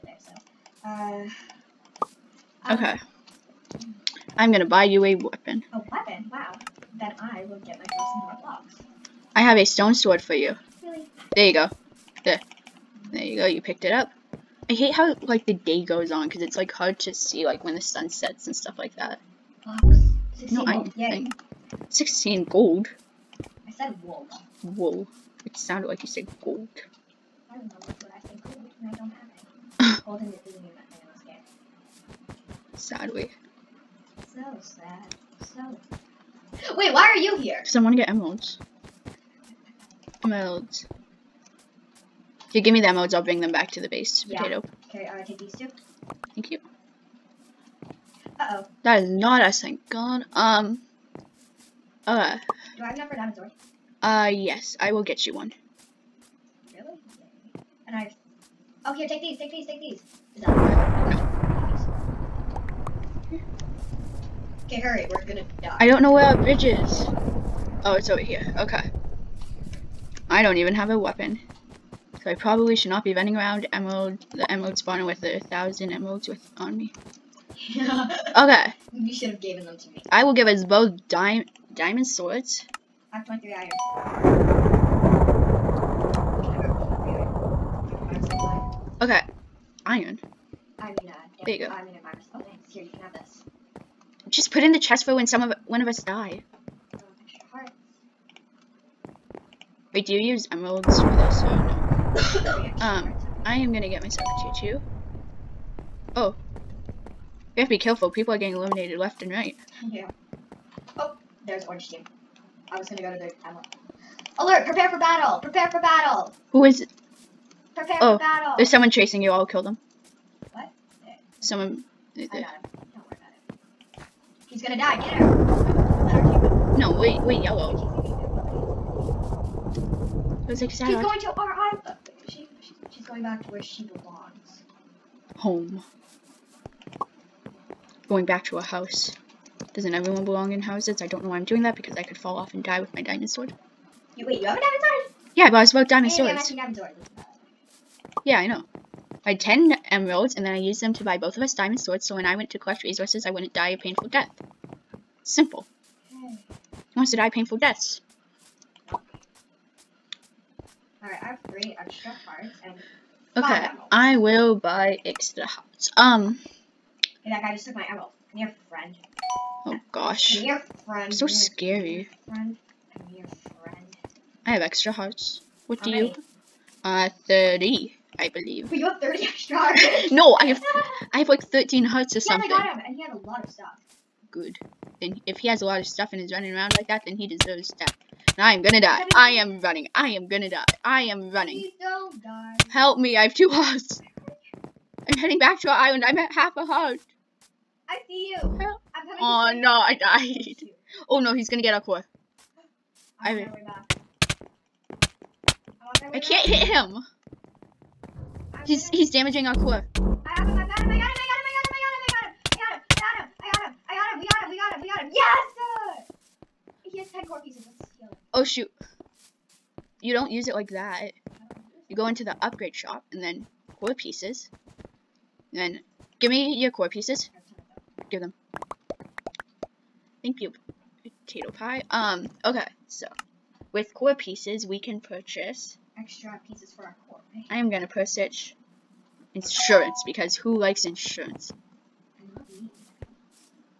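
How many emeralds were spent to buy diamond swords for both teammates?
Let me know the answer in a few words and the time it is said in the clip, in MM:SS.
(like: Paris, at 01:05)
10, at 02:29.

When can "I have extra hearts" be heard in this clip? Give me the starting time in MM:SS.
02:54.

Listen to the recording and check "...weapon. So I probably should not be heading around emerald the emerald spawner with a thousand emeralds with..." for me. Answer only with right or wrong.
wrong.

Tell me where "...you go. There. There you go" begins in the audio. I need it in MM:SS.
00:11.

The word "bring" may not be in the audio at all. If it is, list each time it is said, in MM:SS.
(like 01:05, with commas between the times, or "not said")
00:43.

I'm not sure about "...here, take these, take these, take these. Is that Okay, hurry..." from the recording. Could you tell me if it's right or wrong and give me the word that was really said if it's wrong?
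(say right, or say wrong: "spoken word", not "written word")
right.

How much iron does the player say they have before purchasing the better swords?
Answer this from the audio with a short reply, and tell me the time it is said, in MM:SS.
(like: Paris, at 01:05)
23, at 01:23.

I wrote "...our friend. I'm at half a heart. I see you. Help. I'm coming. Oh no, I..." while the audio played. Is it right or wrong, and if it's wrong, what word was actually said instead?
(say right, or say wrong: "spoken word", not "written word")
wrong: "island", not "friend".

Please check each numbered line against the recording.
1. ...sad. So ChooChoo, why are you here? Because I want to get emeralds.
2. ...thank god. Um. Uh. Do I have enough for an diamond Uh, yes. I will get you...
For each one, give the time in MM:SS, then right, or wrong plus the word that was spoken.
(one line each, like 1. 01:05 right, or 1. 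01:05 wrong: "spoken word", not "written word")
1. 00:34 wrong: "Wait", not "ChooChoo"
2. 00:49 right.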